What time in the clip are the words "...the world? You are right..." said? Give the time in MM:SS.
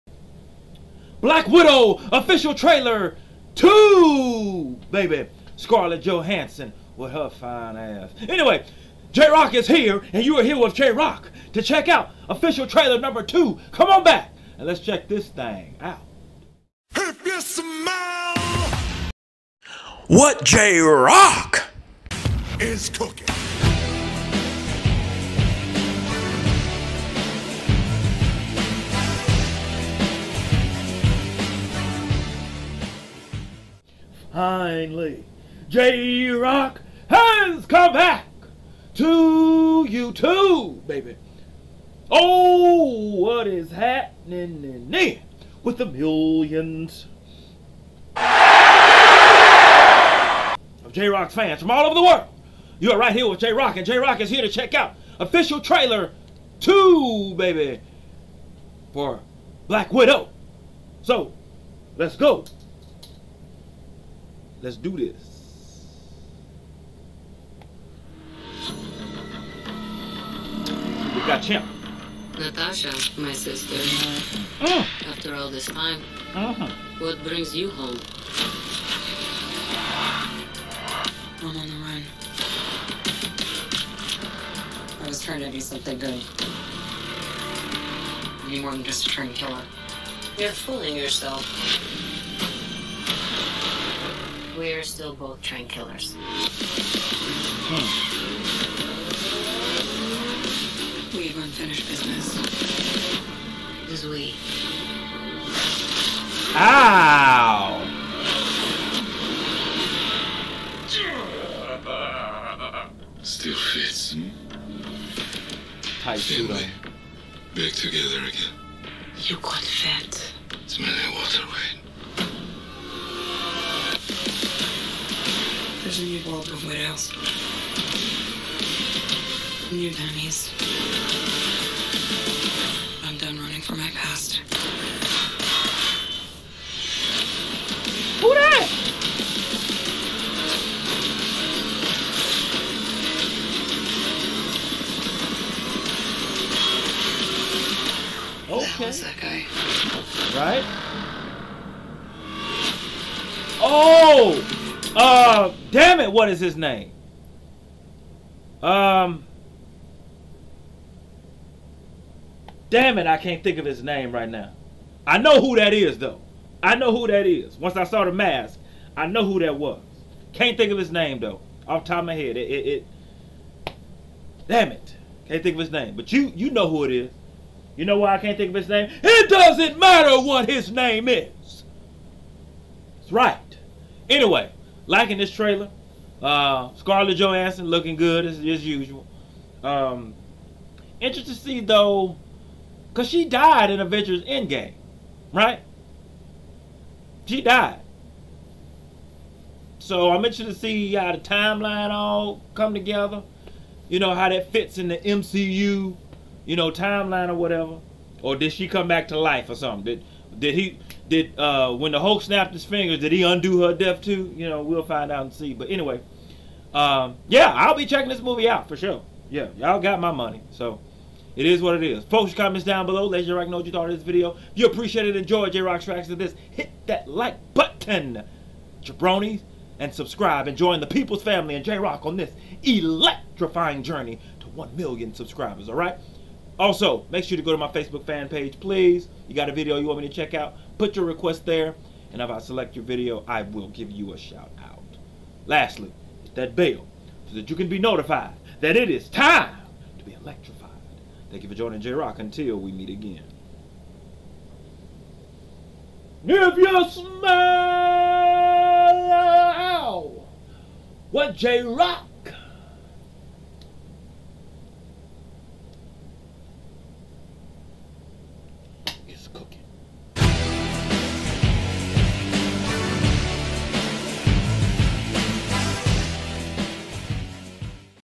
00:51.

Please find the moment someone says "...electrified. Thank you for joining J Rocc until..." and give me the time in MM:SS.
04:10.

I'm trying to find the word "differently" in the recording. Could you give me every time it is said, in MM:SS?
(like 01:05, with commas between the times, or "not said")
not said.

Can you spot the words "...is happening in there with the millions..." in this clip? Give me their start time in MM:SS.
00:43.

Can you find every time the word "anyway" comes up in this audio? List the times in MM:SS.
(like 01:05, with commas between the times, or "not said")
00:08, 03:04, 03:35.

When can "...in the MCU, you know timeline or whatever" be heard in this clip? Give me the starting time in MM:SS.
03:24.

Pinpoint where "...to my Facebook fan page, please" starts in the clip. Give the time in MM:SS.
03:57.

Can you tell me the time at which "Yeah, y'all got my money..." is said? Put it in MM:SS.
03:39.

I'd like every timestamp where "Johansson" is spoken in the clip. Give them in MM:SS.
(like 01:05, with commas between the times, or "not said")
00:06, 03:07.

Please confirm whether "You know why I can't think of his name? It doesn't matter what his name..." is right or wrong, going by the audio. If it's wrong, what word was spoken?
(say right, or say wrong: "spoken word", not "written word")
right.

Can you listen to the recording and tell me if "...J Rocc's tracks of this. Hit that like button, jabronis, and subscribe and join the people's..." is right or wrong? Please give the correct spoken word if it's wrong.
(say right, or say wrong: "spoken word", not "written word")
right.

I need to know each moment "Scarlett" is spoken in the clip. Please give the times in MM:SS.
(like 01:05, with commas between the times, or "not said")
00:05, 03:06.